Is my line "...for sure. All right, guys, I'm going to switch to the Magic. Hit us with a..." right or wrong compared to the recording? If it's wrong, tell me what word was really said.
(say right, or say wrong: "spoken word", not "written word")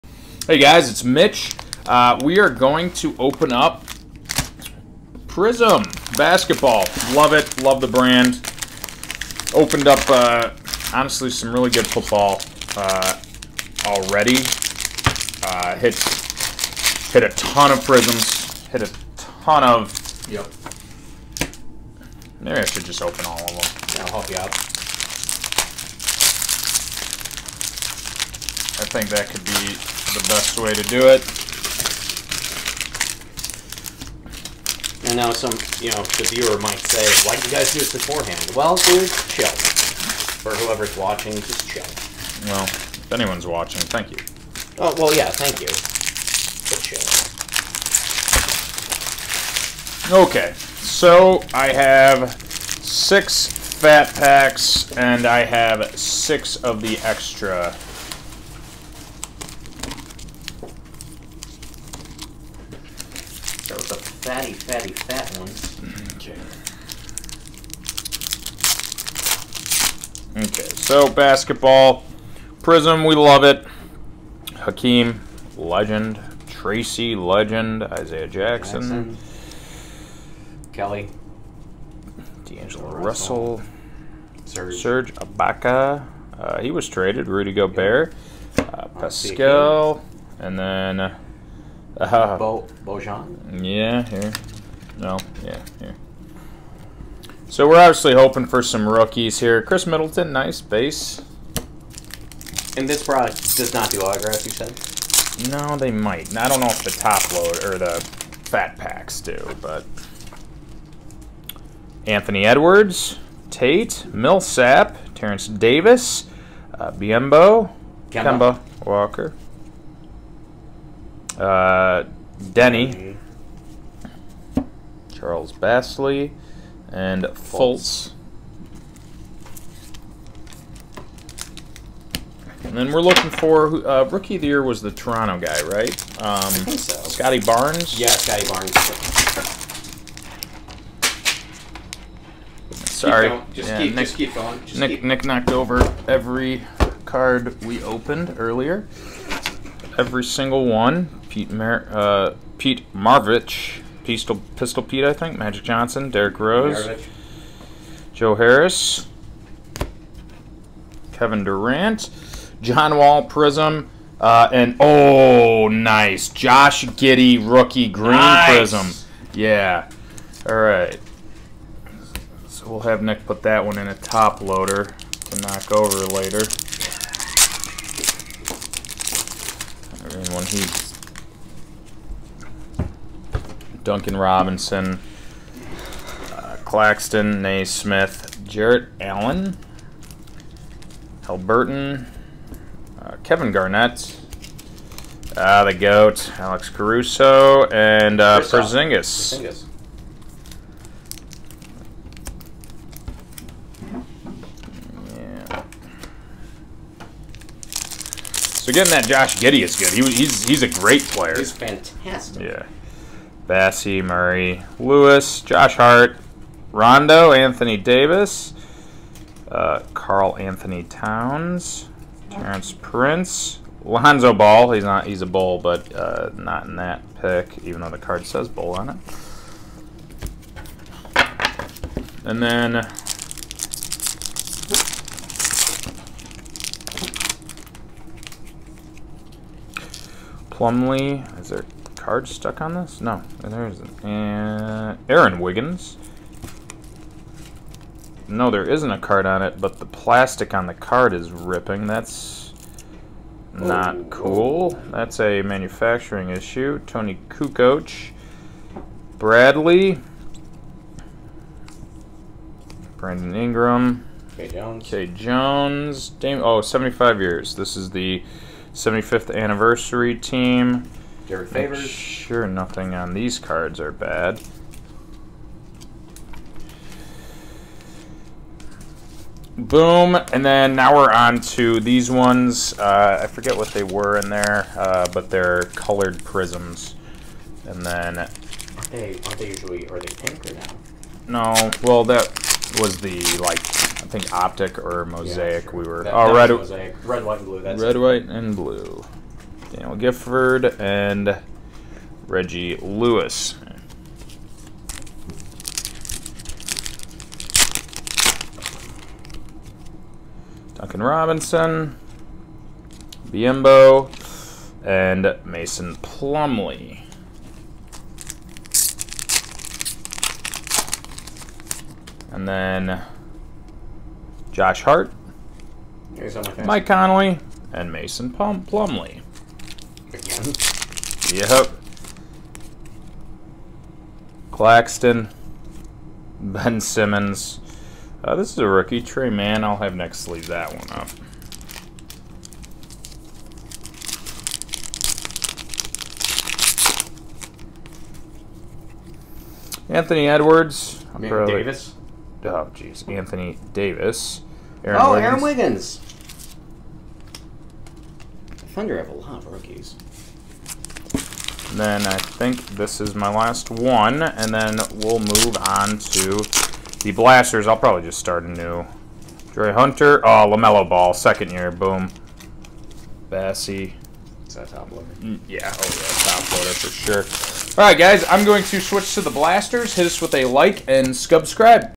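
wrong: "Blasters", not "Magic".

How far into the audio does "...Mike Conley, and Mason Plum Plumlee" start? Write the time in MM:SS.
05:26.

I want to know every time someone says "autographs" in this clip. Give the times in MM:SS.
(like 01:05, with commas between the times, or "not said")
01:43.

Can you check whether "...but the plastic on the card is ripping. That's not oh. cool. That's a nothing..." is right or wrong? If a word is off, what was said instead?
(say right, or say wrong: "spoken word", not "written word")
wrong: "manufacturing", not "nothing".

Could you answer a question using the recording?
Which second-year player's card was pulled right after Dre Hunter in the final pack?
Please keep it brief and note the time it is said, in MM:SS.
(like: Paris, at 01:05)
LaMelo Ball, at 06:10.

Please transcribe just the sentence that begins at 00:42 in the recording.
Well, if anyone's watching, thank you.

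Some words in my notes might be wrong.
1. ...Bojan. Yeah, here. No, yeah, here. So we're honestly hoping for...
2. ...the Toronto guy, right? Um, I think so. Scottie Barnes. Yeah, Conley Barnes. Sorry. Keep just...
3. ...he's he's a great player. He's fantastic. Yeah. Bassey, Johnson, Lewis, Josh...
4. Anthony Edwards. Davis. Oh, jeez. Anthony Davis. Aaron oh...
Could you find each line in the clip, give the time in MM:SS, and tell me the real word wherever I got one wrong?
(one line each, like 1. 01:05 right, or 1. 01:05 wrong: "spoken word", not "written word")
1. 01:32 wrong: "obviously", not "honestly"
2. 02:14 wrong: "Scottie", not "Conley"
3. 03:30 wrong: "Murray", not "Johnson"
4. 05:49 right.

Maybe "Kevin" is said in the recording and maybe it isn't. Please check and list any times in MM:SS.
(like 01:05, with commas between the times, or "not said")
02:41, 03:13.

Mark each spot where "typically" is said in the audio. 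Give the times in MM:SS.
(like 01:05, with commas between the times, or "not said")
not said.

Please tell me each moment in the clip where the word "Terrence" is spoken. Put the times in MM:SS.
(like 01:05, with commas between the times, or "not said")
01:55, 03:42.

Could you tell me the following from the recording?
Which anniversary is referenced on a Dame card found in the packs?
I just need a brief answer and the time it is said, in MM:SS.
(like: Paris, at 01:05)
75th anniversary, at 04:28.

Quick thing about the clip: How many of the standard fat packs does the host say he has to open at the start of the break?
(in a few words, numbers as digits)
6.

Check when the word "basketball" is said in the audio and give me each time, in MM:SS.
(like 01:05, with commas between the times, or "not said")
00:06, 01:11.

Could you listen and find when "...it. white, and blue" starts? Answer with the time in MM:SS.
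04:57.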